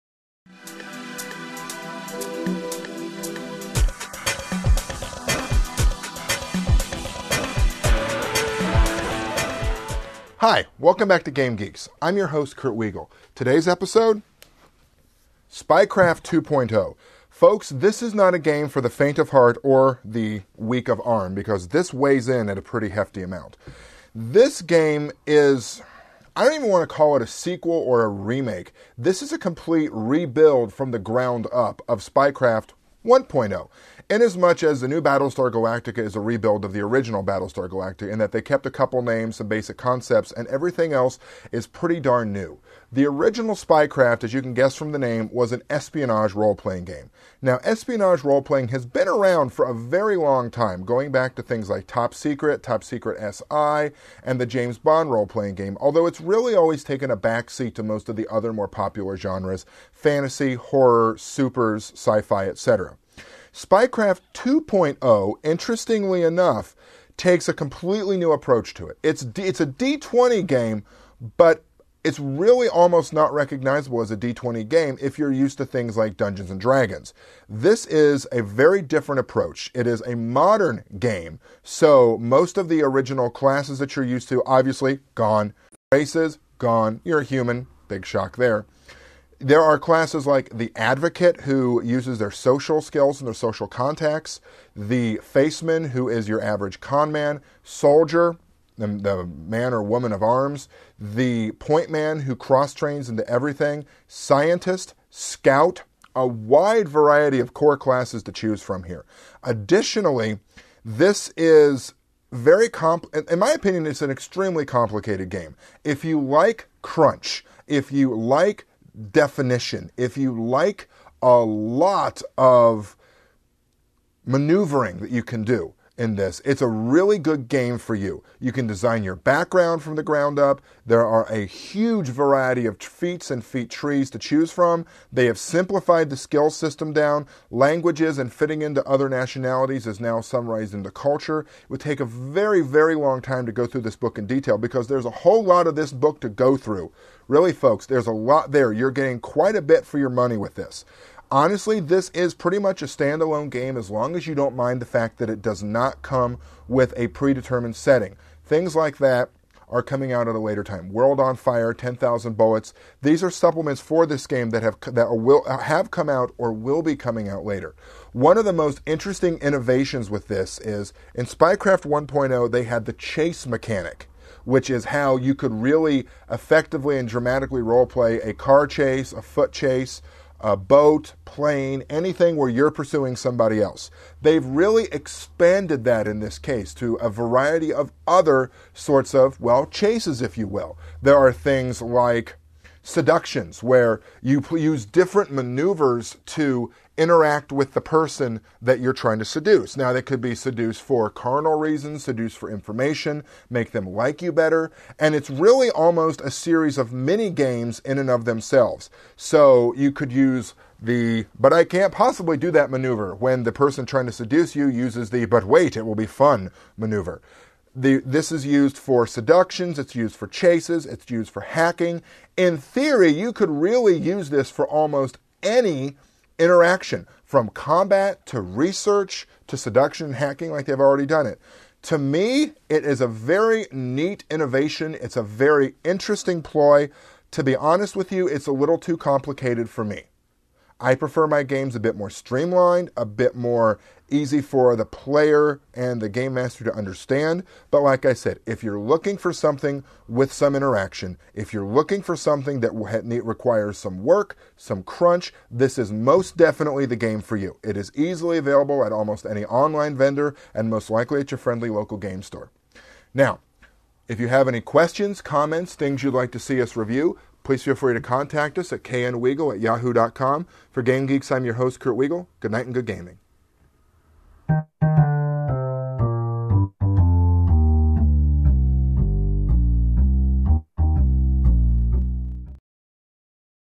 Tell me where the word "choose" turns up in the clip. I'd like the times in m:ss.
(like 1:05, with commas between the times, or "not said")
1:48, 2:14.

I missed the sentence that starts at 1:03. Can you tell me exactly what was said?
Spycraft 2.0, interestingly enough, takes a completely new approach to it.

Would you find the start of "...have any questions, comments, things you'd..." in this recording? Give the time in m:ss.
4:24.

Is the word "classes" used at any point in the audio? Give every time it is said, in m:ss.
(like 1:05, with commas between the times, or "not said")
1:23, 1:29, 1:47.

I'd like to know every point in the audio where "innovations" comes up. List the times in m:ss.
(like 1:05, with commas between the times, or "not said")
2:49, 3:54.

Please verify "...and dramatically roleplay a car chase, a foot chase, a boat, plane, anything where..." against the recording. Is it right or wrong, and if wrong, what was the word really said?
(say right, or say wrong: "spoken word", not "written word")
right.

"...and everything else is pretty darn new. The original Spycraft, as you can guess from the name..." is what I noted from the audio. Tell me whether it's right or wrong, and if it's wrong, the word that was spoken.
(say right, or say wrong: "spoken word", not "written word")
right.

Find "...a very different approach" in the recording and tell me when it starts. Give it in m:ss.
1:18.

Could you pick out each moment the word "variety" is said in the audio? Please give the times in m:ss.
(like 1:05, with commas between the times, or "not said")
1:46, 2:12, 3:07.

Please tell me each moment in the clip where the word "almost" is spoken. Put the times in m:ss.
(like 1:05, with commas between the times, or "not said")
1:12, 3:25, 3:44, 4:18.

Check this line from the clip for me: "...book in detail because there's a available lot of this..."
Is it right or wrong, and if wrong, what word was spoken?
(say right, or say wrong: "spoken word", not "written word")
wrong: "whole", not "available".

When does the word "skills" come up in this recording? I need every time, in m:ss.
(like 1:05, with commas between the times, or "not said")
1:32, 2:16.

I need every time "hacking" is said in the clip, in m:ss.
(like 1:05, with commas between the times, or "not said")
3:41, 3:50.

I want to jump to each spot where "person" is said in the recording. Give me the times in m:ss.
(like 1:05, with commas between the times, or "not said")
3:17, 3:33.